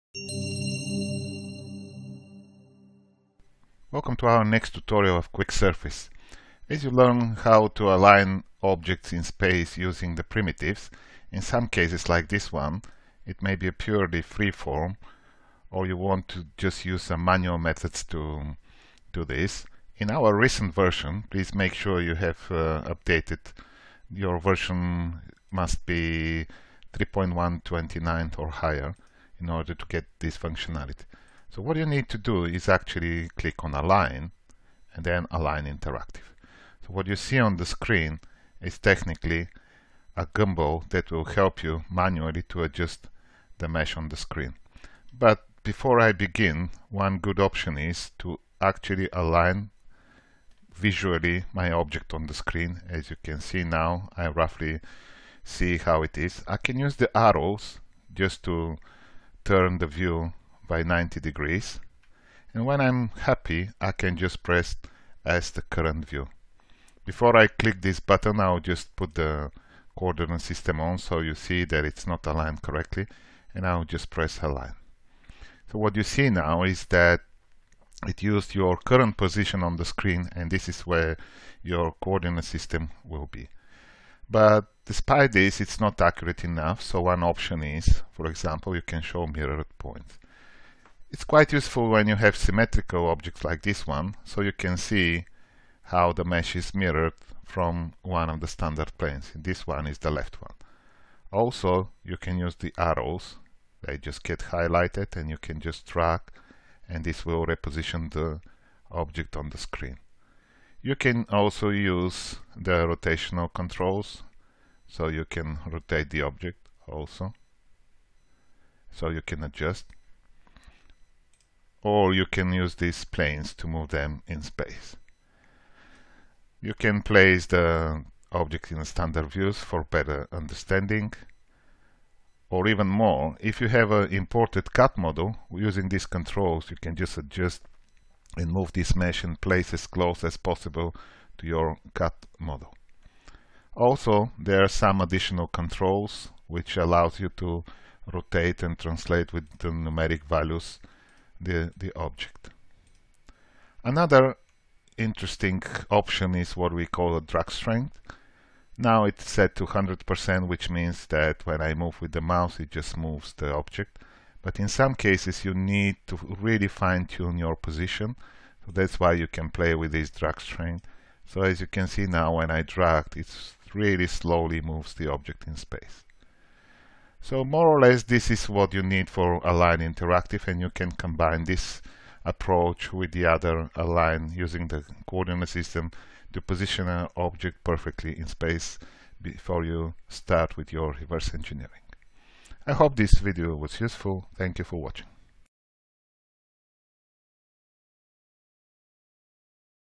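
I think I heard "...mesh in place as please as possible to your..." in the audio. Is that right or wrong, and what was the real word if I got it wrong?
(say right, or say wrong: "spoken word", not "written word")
wrong: "close", not "please".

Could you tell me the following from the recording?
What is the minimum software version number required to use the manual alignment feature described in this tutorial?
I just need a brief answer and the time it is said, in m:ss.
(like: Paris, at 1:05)
3.129, at 0:26.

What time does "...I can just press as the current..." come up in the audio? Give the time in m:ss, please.
1:03.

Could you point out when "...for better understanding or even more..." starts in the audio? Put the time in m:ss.
2:09.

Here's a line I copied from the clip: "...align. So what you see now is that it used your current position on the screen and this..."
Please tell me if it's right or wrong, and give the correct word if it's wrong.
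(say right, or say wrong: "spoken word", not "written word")
right.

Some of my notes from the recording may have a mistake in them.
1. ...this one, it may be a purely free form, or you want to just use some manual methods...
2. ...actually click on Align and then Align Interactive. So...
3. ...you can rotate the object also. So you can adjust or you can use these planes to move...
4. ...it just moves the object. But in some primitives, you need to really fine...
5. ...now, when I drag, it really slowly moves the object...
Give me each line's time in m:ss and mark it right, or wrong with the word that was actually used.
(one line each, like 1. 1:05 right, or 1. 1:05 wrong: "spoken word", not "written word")
1. 0:12 right
2. 0:32 right
3. 1:55 right
4. 2:42 wrong: "cases", not "primitives"
5. 2:52 right.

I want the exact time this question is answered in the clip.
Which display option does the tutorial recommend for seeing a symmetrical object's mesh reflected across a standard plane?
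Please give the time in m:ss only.
1:29.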